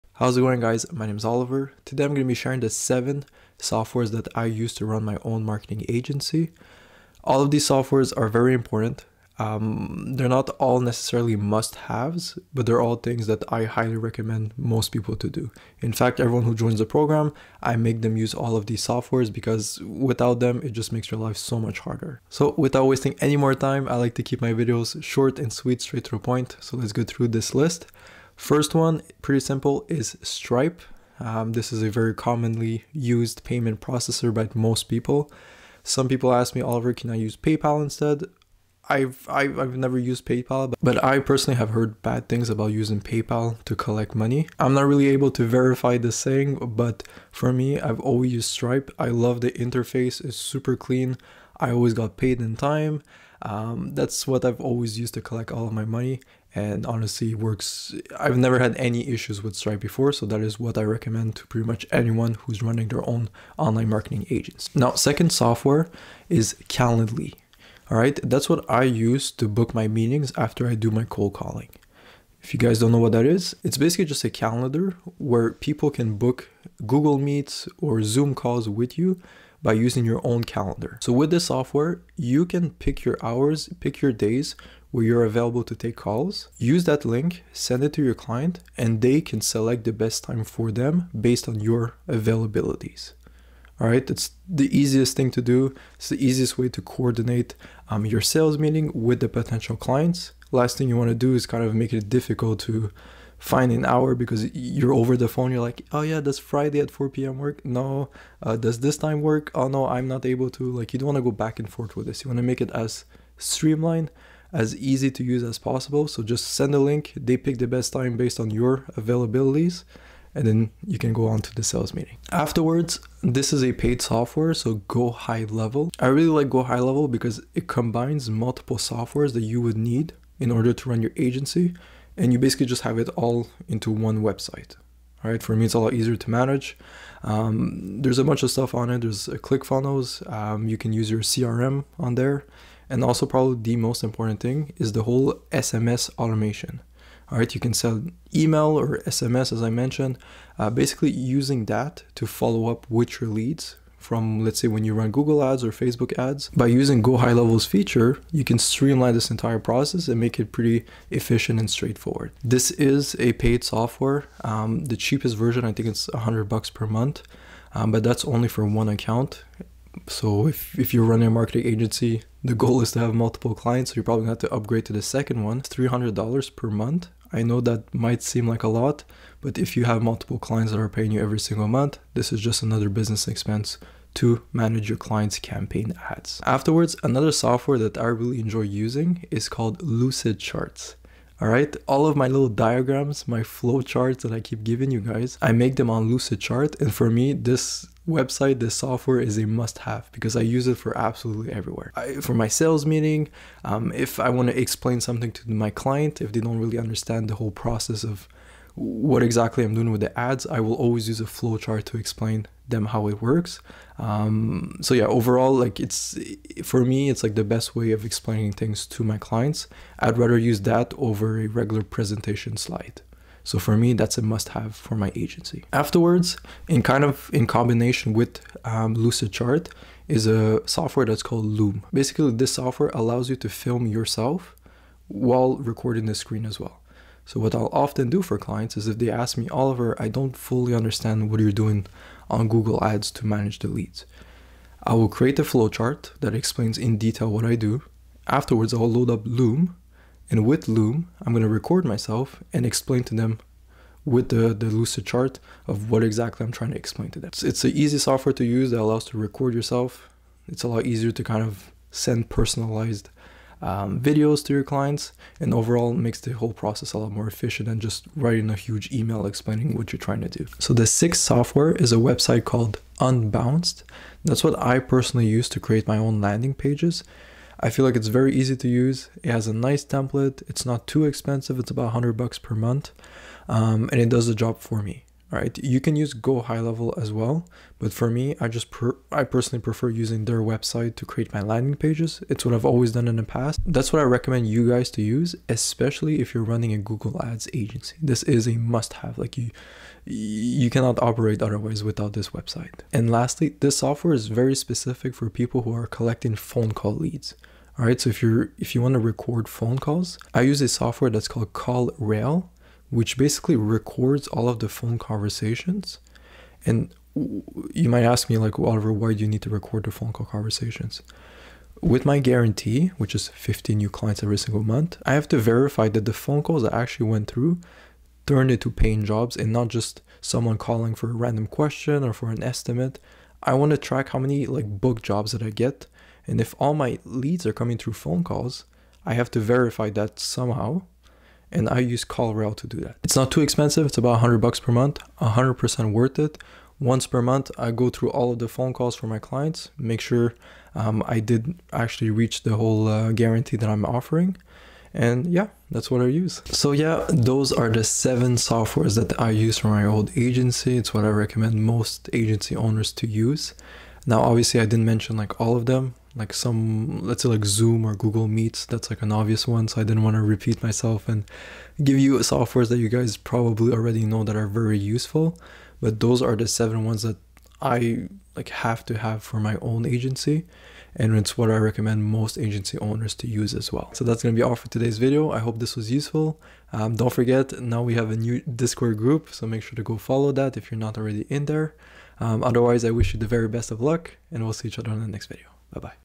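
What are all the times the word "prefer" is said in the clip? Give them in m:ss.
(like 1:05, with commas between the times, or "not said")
4:49.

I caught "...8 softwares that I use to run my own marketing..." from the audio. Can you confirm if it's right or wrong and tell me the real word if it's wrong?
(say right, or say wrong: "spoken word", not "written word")
wrong: "7", not "8".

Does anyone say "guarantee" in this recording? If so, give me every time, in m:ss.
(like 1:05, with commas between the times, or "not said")
5:22, 5:53.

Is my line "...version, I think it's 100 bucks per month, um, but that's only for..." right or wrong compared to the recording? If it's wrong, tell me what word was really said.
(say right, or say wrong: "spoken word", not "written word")
right.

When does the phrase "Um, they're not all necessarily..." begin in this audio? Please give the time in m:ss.
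0:09.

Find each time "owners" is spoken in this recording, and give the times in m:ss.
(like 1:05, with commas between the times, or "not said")
6:02, 6:22.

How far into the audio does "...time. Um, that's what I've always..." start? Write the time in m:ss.
0:52.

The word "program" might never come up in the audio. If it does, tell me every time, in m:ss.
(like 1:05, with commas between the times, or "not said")
0:16.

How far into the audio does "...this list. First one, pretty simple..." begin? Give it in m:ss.
0:27.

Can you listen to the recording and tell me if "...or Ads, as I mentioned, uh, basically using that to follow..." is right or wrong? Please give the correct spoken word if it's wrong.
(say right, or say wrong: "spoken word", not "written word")
wrong: "SMS", not "Ads".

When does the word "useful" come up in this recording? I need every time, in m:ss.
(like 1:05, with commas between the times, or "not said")
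6:14, 6:25.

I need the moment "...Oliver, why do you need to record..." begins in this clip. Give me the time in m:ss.
5:18.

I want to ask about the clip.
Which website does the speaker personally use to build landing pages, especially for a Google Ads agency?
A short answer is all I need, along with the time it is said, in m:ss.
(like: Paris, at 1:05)
Unbounce, at 4:32.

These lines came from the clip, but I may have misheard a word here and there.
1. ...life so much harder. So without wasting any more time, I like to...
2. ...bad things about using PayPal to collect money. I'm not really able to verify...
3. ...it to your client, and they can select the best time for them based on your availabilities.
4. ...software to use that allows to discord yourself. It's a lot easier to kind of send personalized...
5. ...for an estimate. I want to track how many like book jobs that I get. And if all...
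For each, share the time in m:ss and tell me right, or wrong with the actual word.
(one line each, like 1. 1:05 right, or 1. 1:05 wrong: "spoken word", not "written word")
1. 0:21 right
2. 0:42 right
3. 1:27 right
4. 4:17 wrong: "record", not "discord"
5. 5:32 right.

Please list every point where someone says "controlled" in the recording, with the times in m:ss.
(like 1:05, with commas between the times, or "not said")
not said.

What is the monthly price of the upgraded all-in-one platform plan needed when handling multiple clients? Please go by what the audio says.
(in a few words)
$300.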